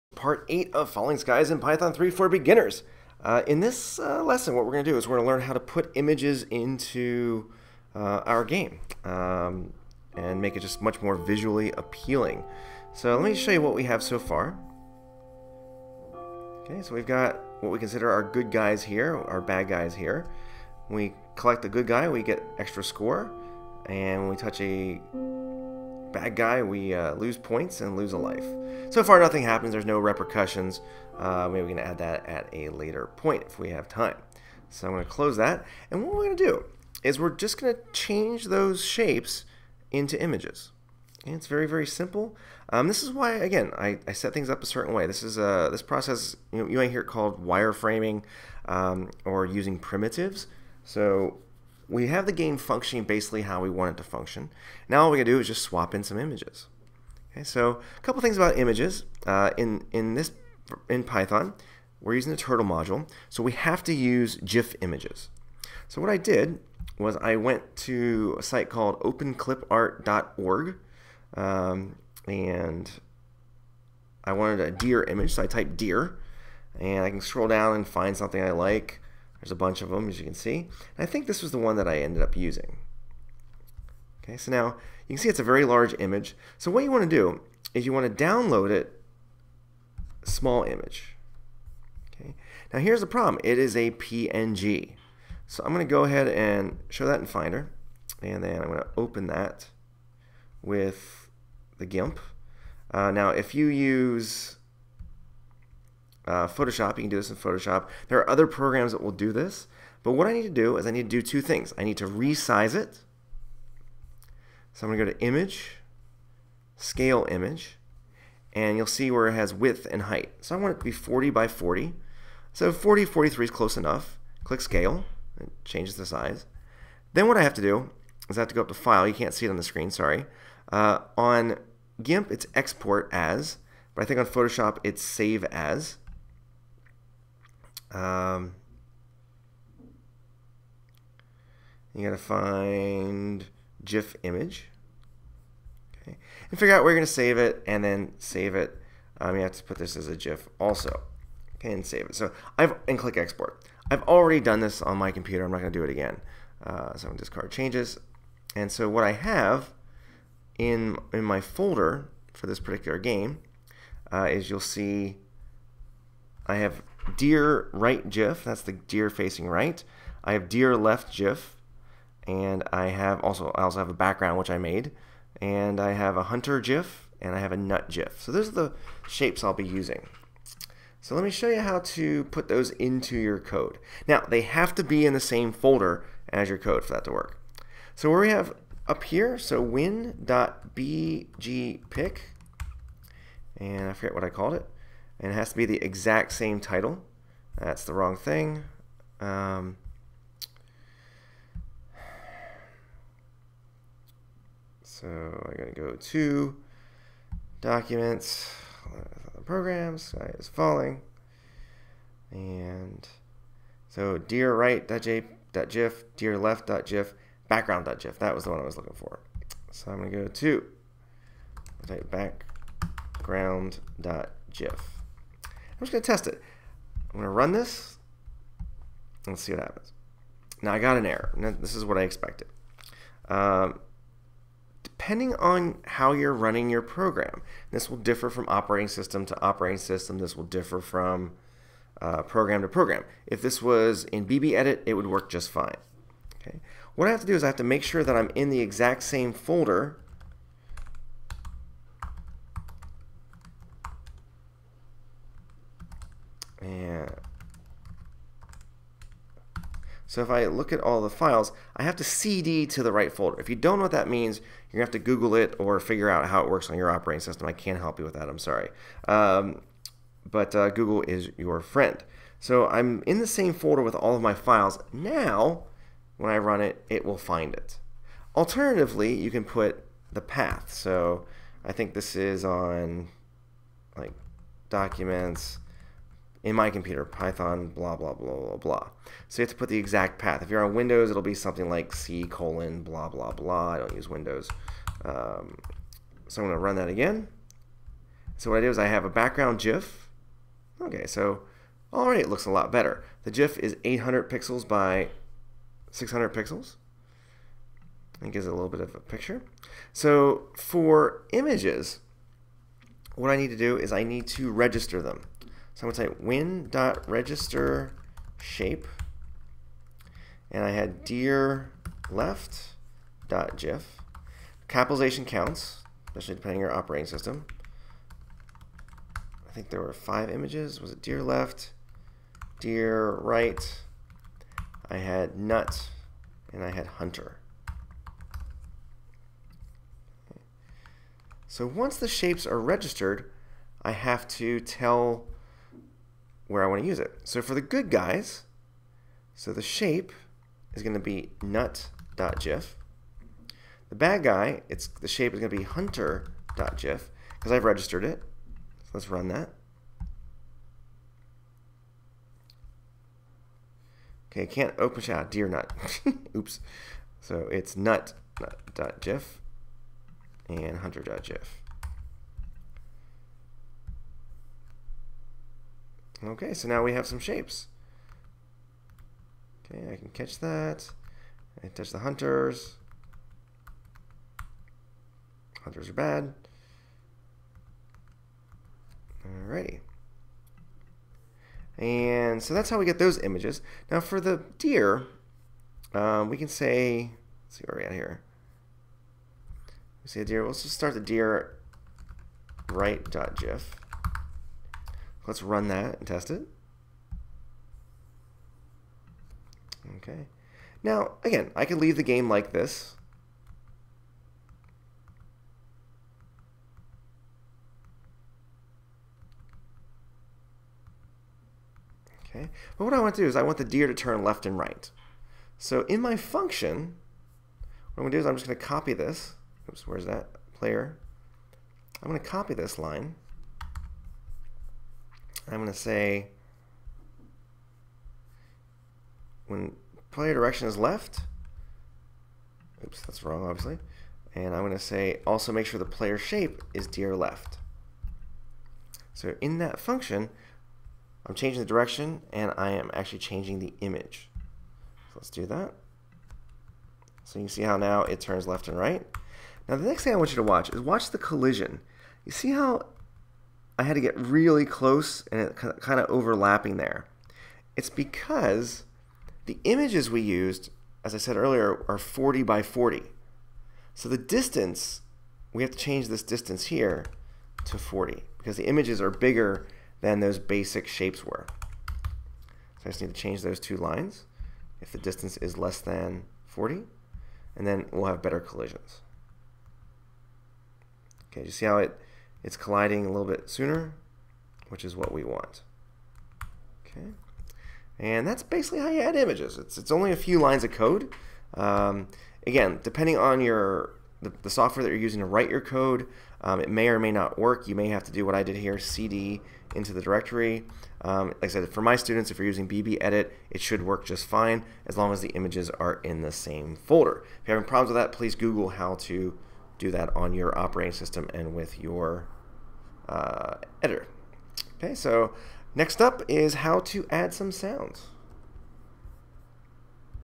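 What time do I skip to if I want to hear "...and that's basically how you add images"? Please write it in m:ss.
8:17.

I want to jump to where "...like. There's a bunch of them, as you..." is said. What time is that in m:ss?
1:18.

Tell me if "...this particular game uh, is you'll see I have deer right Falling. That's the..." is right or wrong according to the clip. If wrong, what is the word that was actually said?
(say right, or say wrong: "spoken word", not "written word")
wrong: "GIF", not "Falling".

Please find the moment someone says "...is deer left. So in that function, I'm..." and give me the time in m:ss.
7:26.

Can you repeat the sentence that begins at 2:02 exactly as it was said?
So 40, 43 is close enough.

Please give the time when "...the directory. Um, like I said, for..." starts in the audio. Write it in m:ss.
8:29.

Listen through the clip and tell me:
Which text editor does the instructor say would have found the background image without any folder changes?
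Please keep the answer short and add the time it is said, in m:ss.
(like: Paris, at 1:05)
BB Edit, at 4:04.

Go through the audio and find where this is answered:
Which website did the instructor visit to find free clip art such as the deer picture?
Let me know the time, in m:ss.
1:09.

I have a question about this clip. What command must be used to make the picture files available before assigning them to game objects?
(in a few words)
register shape.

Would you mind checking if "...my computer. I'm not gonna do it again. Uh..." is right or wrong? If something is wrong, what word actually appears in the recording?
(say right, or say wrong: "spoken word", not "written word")
right.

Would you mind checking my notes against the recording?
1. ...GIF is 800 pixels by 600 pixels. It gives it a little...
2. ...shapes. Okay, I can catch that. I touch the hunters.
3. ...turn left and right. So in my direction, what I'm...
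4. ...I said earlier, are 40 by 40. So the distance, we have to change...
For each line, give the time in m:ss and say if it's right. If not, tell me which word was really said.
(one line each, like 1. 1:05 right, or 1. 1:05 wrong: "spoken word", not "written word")
1. 5:03 right
2. 6:17 right
3. 7:03 wrong: "function", not "direction"
4. 7:51 right.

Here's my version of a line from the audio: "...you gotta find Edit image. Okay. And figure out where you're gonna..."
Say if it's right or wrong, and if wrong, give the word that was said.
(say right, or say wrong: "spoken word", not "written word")
wrong: "GIF", not "Edit".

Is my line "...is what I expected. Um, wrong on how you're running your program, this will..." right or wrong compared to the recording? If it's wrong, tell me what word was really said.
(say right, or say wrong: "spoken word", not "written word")
wrong: "depending", not "wrong".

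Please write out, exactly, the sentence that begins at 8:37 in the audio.
If you're having problems with that, please Google how to do that on your operating system and with your uh, editor.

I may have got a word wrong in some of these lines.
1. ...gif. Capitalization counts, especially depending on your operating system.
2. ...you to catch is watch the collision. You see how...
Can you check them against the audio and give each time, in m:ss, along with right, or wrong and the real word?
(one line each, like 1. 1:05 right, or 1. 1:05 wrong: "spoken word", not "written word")
1. 5:23 right
2. 7:40 wrong: "watch", not "catch".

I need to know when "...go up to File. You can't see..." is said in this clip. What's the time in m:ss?
2:08.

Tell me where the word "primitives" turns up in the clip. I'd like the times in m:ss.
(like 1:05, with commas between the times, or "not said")
0:49.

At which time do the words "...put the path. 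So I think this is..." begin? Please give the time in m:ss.
4:39.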